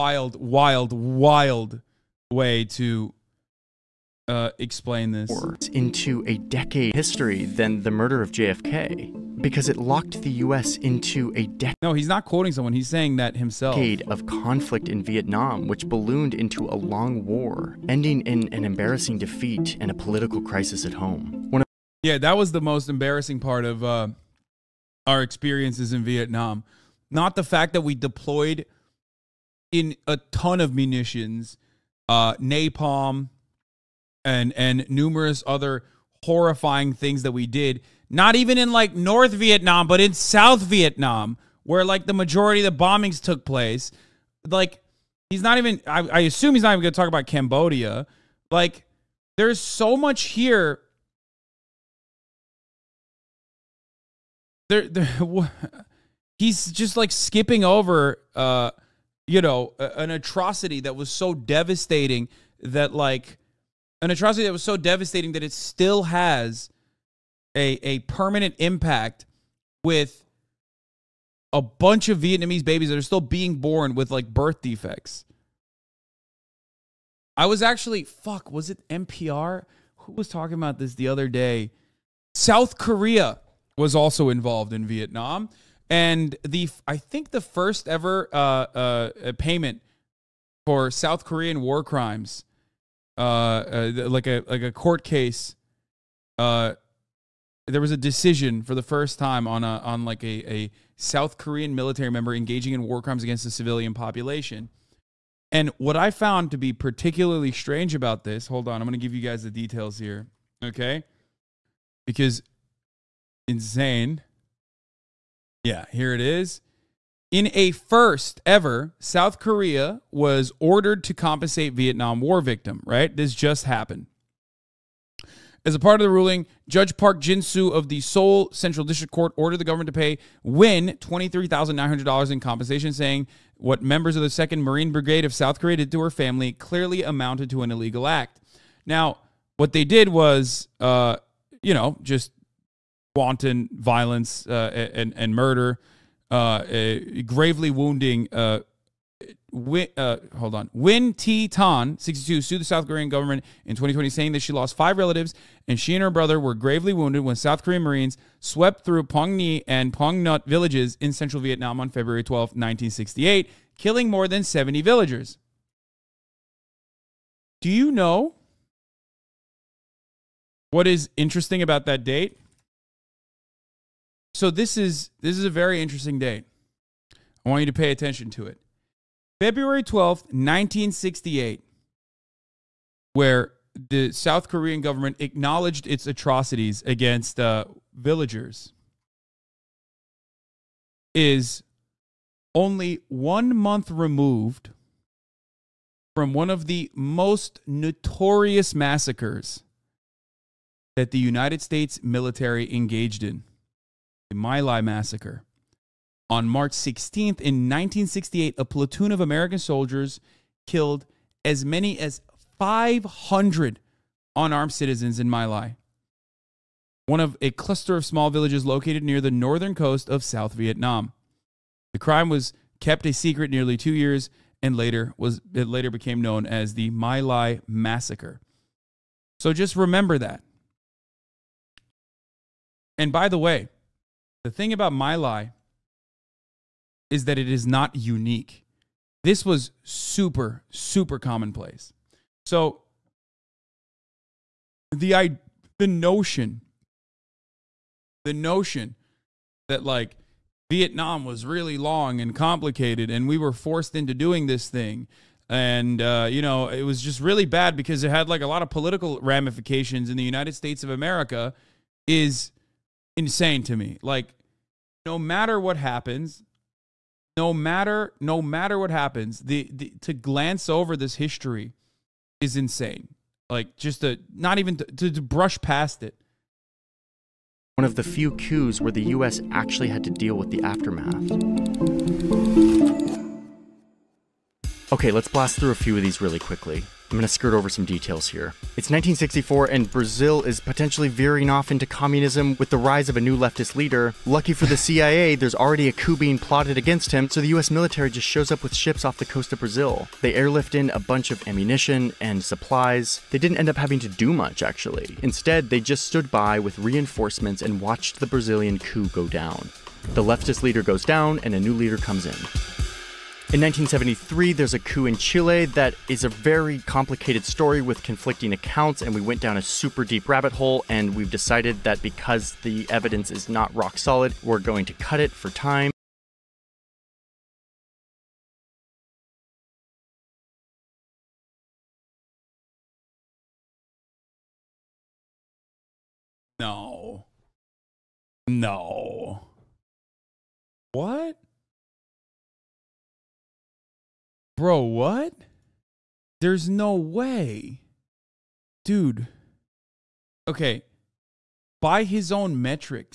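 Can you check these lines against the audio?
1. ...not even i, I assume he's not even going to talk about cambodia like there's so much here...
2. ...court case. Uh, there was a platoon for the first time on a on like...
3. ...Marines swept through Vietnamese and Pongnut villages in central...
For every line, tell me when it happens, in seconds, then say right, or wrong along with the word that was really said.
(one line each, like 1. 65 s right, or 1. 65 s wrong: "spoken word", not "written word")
1. 45 s right
2. 94 s wrong: "decision", not "platoon"
3. 157 s wrong: "Pongni", not "Vietnamese".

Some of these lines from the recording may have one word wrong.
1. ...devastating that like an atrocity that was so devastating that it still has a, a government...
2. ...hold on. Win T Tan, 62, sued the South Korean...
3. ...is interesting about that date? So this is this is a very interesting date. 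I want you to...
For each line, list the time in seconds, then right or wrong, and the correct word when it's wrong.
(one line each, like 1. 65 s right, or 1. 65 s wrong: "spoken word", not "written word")
1. 61 s wrong: "permanent", not "government"
2. 150 s right
3. 170 s right.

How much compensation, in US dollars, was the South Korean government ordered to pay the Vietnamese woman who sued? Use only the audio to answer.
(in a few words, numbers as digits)
$23,900.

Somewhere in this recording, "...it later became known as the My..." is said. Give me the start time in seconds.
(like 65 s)
225 s.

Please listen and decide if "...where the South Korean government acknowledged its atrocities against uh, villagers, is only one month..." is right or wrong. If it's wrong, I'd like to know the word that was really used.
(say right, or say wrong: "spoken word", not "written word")
right.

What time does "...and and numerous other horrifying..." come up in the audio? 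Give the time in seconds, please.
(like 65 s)
34 s.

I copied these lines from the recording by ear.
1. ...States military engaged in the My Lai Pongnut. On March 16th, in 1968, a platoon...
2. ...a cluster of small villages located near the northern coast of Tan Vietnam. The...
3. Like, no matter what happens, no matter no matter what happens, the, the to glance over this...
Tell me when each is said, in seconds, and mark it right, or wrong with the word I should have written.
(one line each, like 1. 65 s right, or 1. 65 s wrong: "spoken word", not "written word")
1. 201 s wrong: "Massacre", not "Pongnut"
2. 217 s wrong: "South", not "Tan"
3. 264 s right.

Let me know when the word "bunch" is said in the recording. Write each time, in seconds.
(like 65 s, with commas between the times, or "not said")
71 s, 300 s.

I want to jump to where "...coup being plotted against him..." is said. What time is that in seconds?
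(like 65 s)
295 s.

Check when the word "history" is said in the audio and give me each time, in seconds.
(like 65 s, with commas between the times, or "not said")
6 s, 271 s.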